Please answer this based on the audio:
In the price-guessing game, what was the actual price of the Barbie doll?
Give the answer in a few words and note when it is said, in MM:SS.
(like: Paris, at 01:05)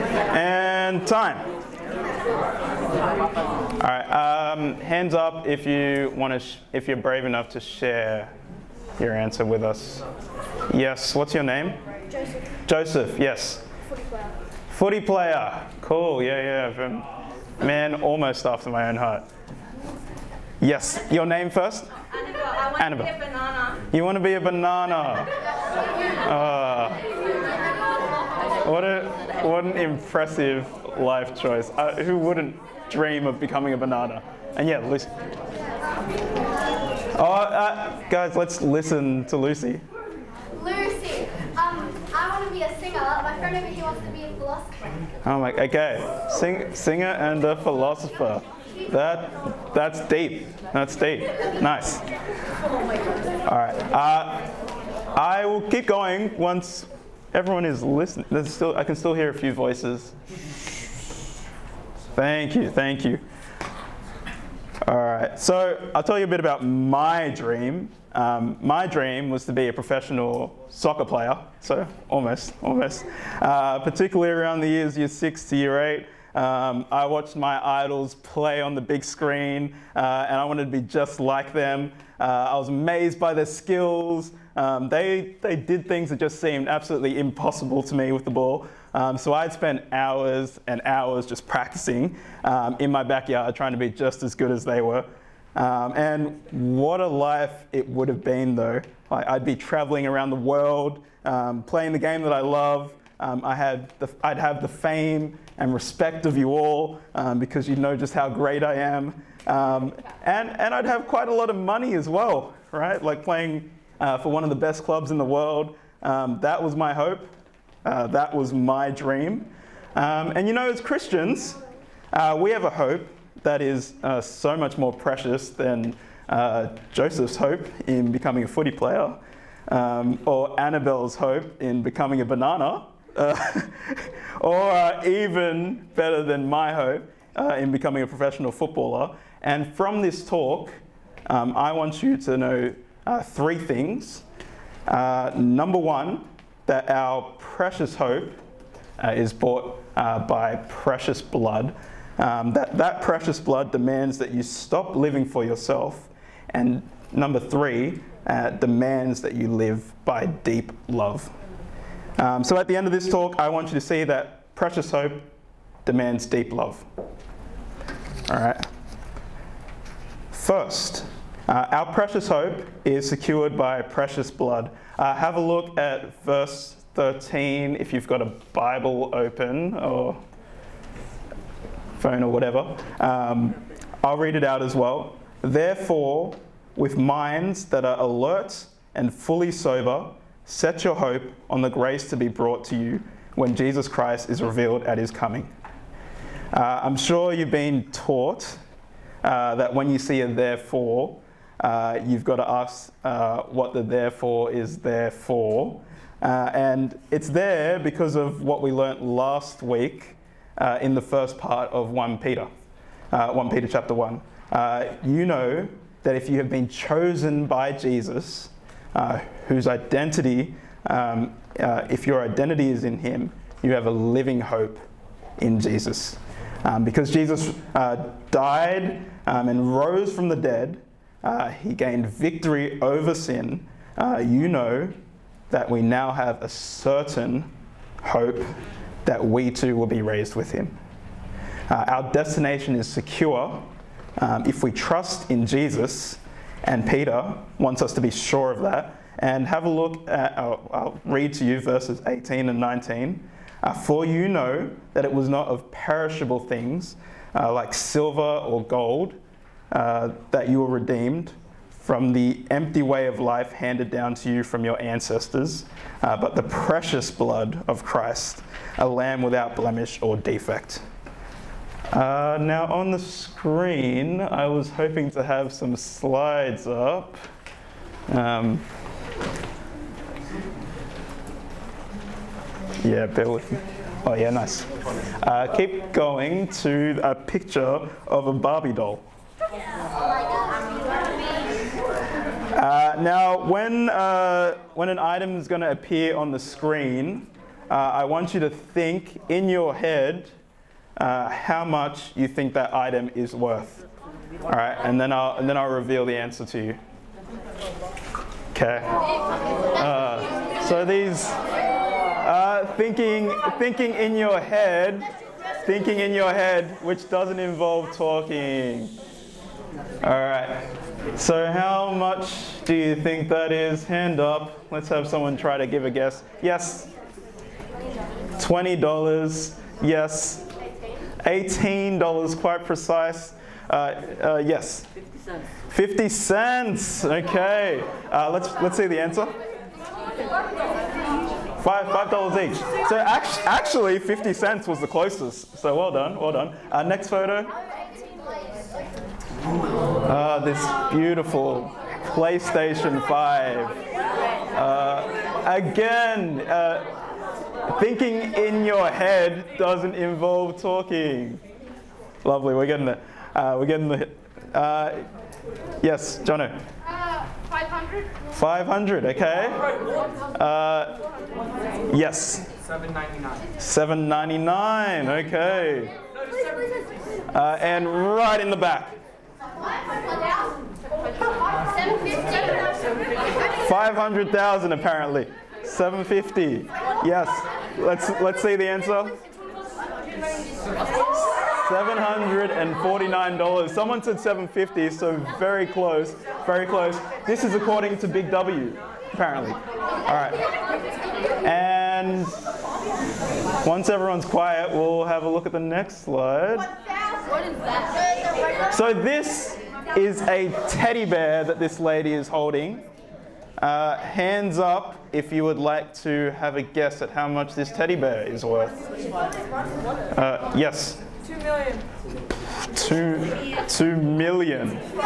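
$5 each, at 05:41.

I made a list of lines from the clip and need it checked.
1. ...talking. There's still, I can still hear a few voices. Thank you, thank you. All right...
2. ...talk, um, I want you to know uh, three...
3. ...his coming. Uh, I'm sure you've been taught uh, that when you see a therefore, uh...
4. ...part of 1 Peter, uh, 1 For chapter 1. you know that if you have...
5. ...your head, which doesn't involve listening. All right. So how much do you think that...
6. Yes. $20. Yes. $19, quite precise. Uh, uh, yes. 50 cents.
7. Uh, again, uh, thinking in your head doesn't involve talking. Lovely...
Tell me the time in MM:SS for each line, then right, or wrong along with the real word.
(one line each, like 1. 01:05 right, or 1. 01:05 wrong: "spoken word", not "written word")
1. 00:57 wrong: "listening", not "talking"
2. 02:20 right
3. 03:14 right
4. 03:31 wrong: "Peter", not "For"
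5. 05:16 wrong: "talking", not "listening"
6. 05:26 wrong: "18", not "19"
7. 05:54 right.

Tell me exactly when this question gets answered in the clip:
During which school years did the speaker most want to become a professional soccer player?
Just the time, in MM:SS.
01:14.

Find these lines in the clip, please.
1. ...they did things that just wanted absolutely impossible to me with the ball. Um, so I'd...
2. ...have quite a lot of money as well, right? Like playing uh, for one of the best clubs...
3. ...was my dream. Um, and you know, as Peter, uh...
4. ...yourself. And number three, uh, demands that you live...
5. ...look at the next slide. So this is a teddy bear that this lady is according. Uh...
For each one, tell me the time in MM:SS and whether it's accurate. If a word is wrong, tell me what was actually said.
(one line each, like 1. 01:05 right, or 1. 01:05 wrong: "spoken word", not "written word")
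1. 01:25 wrong: "seemed", not "wanted"
2. 01:50 right
3. 01:58 wrong: "Christians", not "Peter"
4. 02:35 right
5. 06:45 wrong: "holding", not "according".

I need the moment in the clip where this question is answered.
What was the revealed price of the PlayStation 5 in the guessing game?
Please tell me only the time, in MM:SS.
06:31.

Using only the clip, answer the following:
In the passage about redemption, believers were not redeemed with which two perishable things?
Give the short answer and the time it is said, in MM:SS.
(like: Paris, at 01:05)
Silver or gold, at 04:17.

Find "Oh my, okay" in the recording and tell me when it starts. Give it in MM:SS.
00:45.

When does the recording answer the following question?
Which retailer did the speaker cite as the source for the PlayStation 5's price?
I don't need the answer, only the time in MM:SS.
06:38.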